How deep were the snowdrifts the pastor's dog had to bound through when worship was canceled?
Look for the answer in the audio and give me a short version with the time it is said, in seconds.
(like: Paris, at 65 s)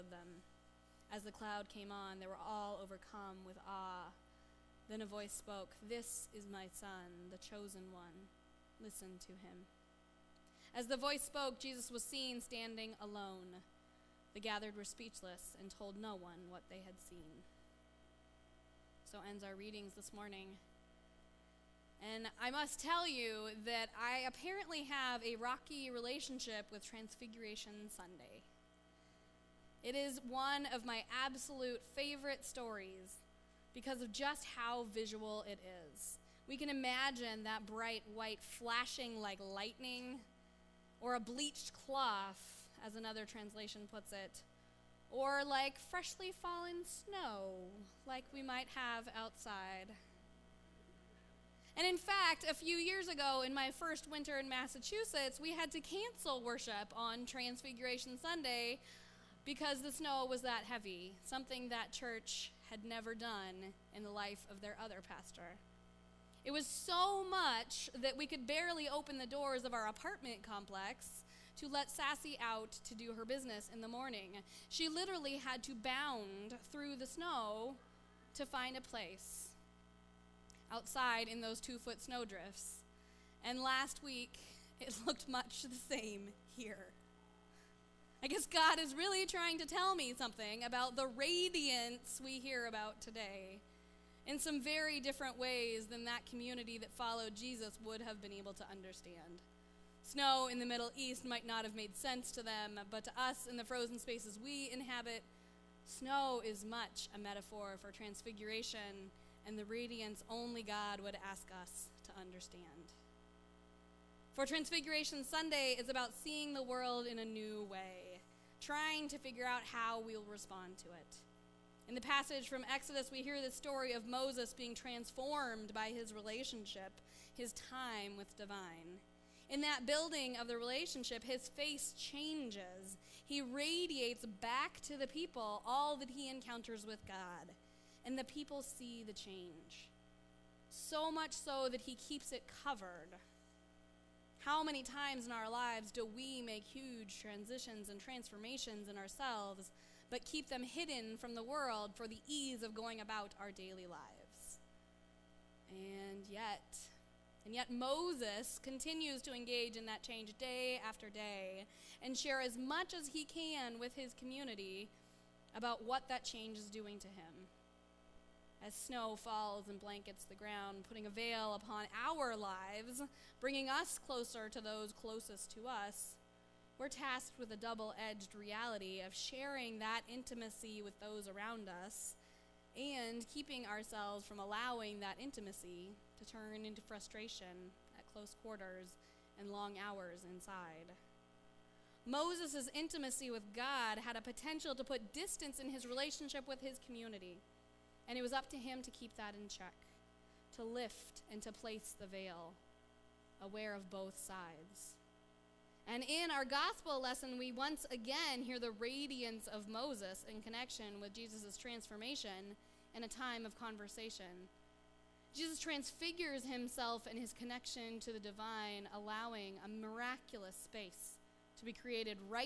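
2 feet, at 81 s.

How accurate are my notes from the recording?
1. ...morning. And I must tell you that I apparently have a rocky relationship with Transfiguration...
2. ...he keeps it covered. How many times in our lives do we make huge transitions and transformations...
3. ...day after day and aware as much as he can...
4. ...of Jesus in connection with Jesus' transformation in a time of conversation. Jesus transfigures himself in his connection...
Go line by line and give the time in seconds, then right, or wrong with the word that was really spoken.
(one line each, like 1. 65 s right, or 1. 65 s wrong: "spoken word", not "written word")
1. 20 s right
2. 141 s right
3. 160 s wrong: "share", not "aware"
4. 209 s wrong: "Moses", not "Jesus".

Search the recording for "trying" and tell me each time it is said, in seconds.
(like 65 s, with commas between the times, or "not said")
89 s, 118 s.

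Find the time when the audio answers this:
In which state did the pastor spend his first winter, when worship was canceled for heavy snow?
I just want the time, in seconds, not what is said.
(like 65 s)
54 s.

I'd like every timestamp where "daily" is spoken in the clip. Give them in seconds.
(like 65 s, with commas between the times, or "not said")
153 s.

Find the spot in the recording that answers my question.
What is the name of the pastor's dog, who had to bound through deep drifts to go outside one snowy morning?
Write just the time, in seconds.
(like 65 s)
71 s.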